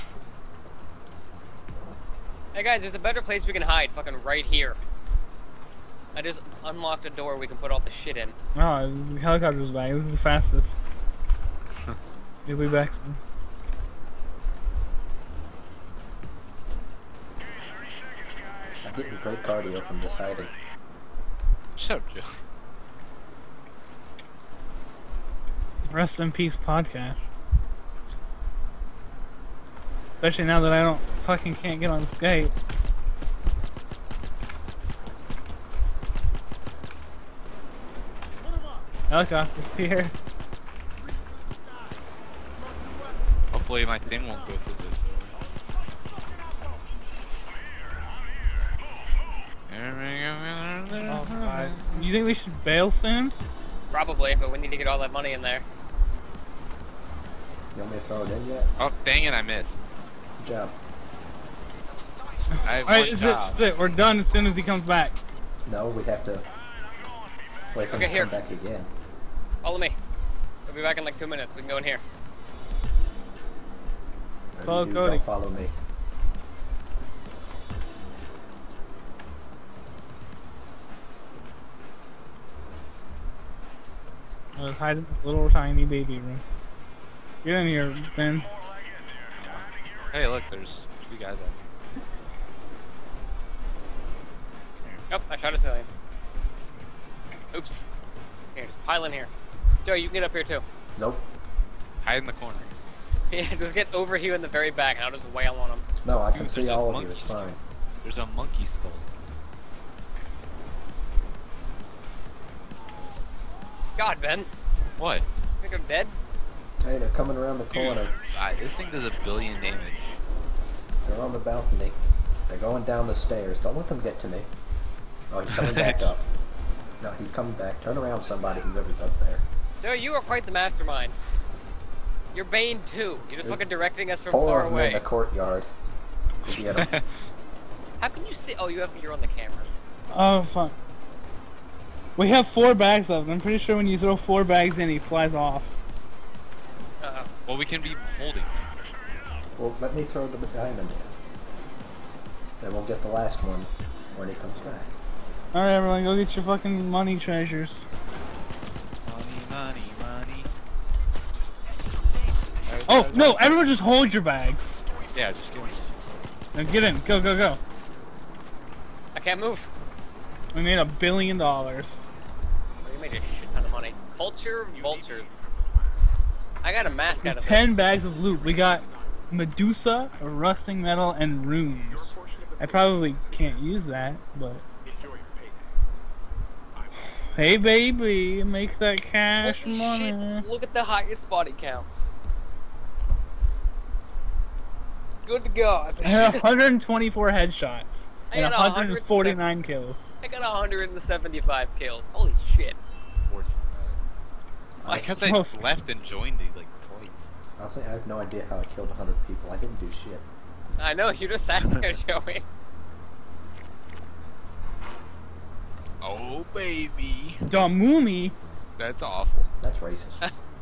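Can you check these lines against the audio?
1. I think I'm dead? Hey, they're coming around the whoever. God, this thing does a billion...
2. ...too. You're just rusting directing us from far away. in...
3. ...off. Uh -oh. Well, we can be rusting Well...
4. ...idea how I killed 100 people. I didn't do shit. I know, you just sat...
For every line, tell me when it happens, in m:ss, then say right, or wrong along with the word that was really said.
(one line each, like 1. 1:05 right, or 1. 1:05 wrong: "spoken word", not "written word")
1. 1:55 wrong: "corner", not "whoever"
2. 2:12 wrong: "looking", not "rusting"
3. 2:25 wrong: "holding", not "rusting"
4. 3:28 right.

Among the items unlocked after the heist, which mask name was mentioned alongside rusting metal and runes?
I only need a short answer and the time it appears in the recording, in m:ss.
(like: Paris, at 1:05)
Medusa, at 2:59.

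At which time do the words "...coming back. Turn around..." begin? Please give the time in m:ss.
2:07.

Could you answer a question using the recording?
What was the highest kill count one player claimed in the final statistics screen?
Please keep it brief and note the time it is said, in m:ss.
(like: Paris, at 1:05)
175, at 3:20.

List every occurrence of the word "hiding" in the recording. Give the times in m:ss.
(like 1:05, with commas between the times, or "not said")
0:20, 1:24.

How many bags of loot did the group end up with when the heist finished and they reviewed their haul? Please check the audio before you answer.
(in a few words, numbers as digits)
10.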